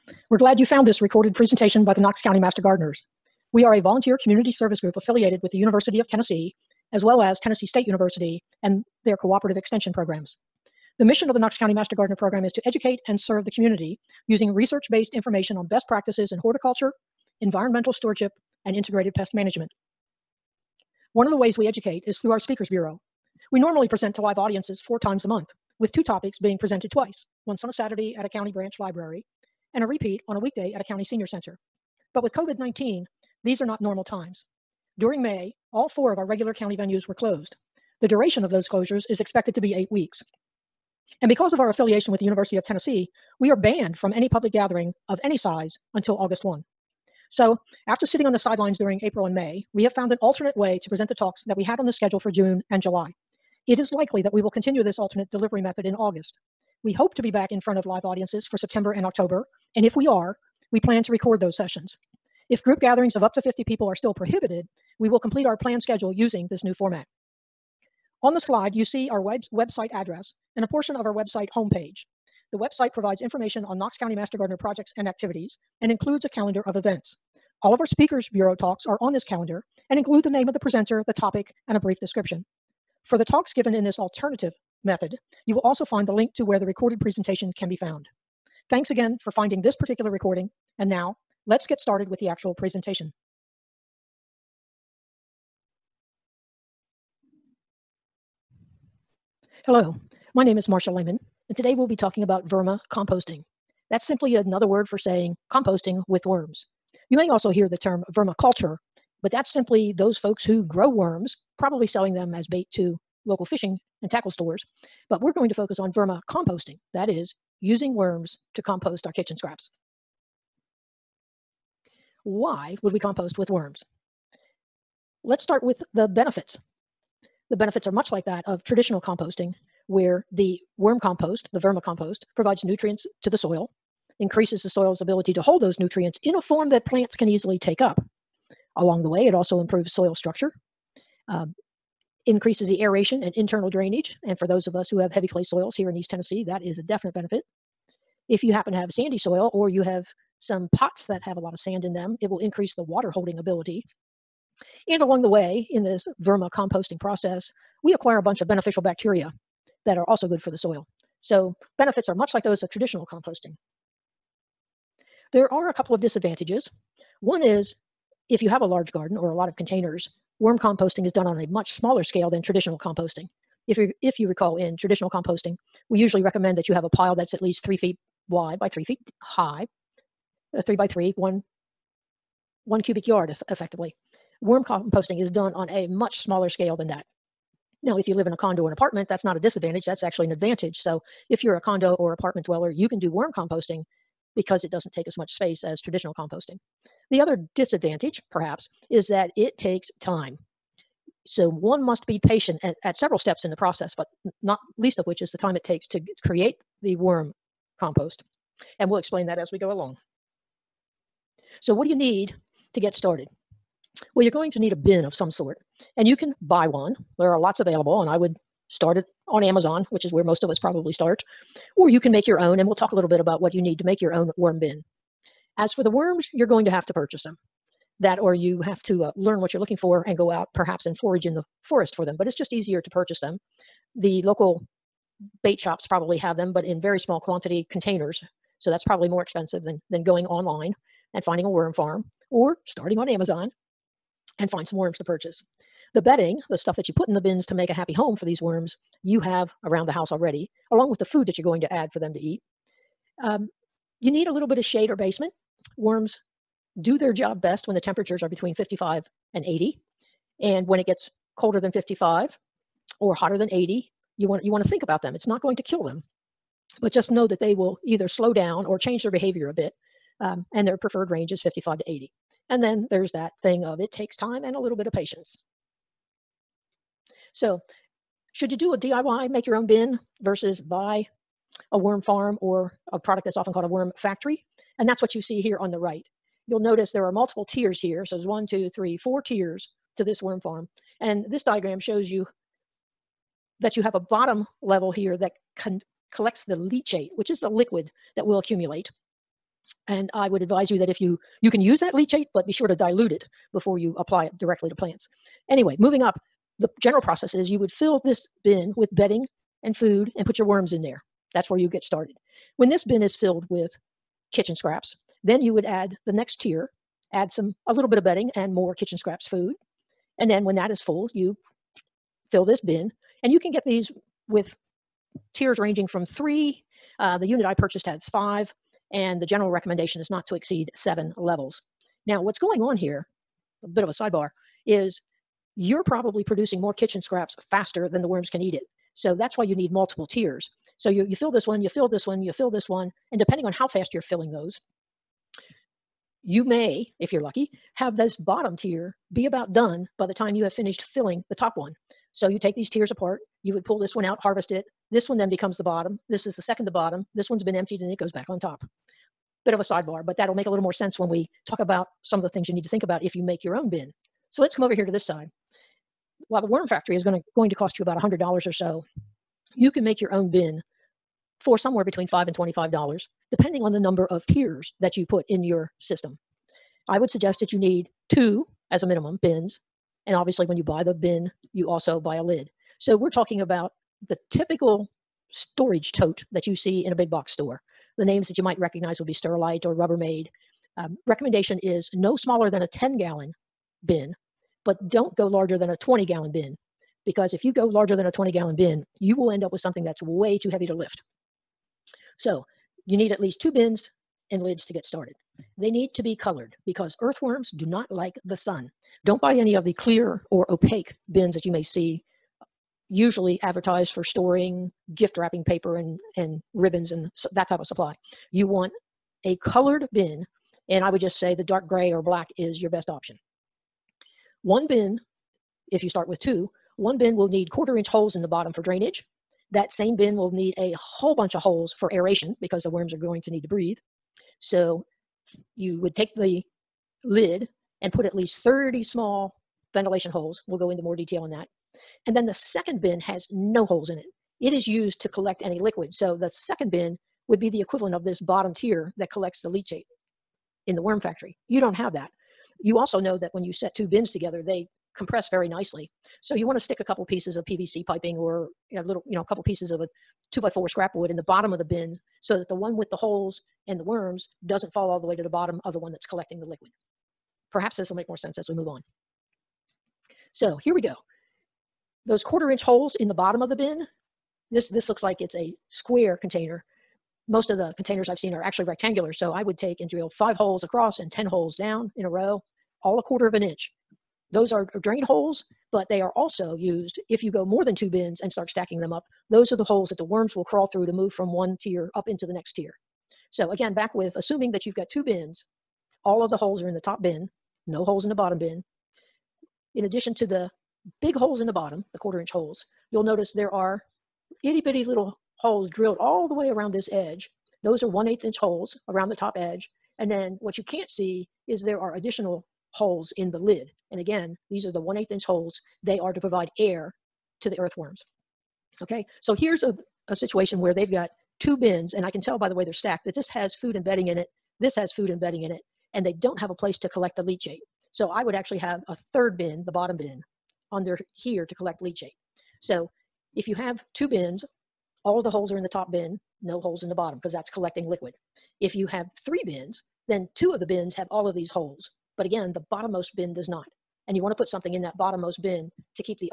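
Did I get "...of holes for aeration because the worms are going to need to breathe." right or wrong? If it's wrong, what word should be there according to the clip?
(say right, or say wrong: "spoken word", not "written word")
right.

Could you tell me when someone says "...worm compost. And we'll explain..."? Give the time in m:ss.
3:26.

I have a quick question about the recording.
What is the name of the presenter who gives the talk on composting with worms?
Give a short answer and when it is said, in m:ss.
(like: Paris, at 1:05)
Marsha Lehman, at 1:40.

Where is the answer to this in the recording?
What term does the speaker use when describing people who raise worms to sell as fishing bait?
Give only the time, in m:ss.
1:48.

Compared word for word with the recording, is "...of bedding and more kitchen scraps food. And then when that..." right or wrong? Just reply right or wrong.
right.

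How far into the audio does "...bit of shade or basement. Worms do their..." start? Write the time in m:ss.
4:14.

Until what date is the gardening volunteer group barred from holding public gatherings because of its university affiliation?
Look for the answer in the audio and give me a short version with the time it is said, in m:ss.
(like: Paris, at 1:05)
August 1, at 0:46.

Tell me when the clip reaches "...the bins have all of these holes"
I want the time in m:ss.
9:00.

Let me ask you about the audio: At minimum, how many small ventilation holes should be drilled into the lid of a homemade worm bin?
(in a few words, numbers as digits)
30.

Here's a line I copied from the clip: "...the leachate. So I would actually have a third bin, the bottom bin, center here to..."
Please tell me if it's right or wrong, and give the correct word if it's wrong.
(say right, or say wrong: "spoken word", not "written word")
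wrong: "under", not "center".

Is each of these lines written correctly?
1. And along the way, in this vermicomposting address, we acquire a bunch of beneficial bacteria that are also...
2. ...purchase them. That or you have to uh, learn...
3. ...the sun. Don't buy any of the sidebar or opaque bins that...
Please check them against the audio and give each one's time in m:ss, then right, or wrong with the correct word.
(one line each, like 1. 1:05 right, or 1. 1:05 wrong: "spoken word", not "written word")
1. 2:34 wrong: "process", not "address"
2. 3:46 right
3. 6:48 wrong: "clear", not "sidebar".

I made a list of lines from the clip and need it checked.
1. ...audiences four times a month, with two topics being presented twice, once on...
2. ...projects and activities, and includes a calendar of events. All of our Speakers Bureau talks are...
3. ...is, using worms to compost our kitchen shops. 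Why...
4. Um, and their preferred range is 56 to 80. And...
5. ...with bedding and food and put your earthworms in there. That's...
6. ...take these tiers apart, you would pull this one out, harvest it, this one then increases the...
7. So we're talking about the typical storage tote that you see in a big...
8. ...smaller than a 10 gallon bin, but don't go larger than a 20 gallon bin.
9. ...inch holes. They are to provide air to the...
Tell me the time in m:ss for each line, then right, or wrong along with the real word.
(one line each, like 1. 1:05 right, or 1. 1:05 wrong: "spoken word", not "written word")
1. 0:24 right
2. 1:14 right
3. 1:57 wrong: "scraps", not "shops"
4. 4:30 wrong: "55", not "56"
5. 5:08 wrong: "worms", not "earthworms"
6. 5:52 wrong: "becomes", not "increases"
7. 6:22 right
8. 6:32 right
9. 8:35 right.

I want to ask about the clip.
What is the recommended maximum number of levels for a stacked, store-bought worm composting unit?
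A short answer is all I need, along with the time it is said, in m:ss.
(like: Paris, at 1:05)
7, at 5:30.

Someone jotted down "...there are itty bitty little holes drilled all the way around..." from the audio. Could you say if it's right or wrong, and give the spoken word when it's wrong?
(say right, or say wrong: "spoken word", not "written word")
right.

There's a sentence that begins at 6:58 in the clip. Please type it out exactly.
You want a colored bin, and I would just say the dark gray or black is your best option.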